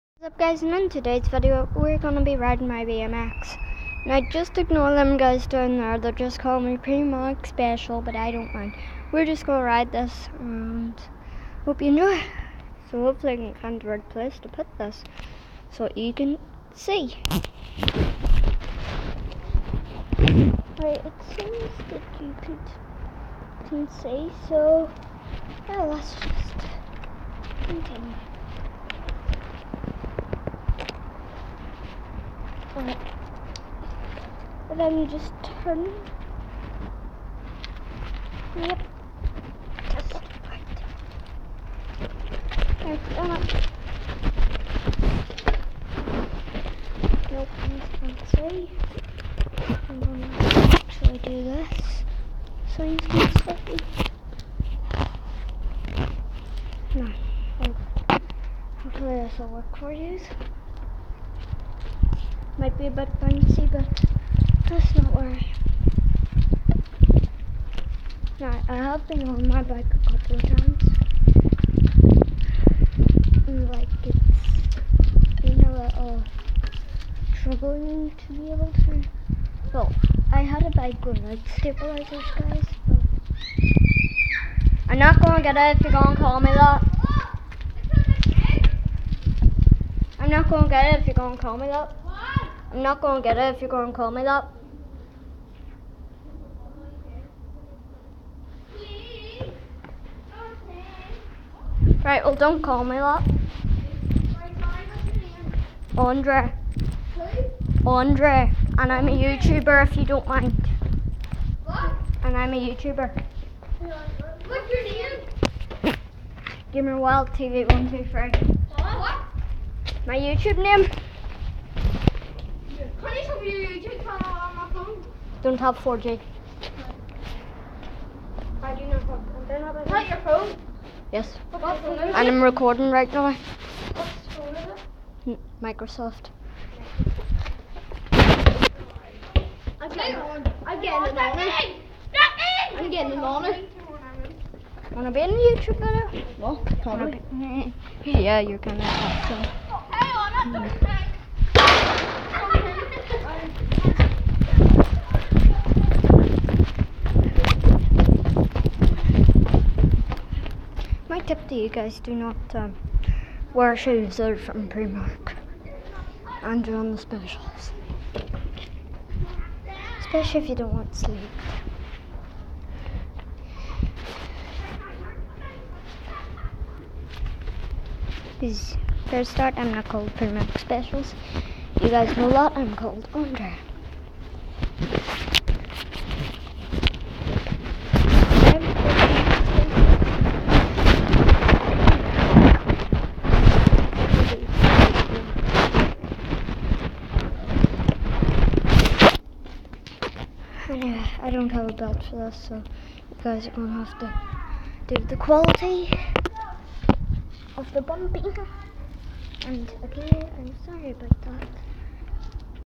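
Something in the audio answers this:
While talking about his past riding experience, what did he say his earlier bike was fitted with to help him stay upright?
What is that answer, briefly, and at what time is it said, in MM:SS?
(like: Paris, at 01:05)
Stabilizers, at 01:21.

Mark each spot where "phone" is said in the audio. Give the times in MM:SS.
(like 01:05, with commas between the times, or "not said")
02:04, 02:10.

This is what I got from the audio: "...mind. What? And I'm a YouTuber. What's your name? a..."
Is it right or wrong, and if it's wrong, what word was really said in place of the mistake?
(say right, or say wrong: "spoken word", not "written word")
right.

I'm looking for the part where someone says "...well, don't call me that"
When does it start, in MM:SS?
01:42.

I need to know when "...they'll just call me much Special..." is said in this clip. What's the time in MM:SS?
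00:05.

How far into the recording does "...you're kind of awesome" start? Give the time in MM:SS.
02:28.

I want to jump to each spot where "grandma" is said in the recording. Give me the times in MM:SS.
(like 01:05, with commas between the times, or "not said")
not said.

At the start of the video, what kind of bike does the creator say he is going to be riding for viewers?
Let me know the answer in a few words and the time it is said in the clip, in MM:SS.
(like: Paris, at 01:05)
BMX, at 00:02.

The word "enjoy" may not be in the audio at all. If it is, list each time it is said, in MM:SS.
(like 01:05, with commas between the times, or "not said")
00:11.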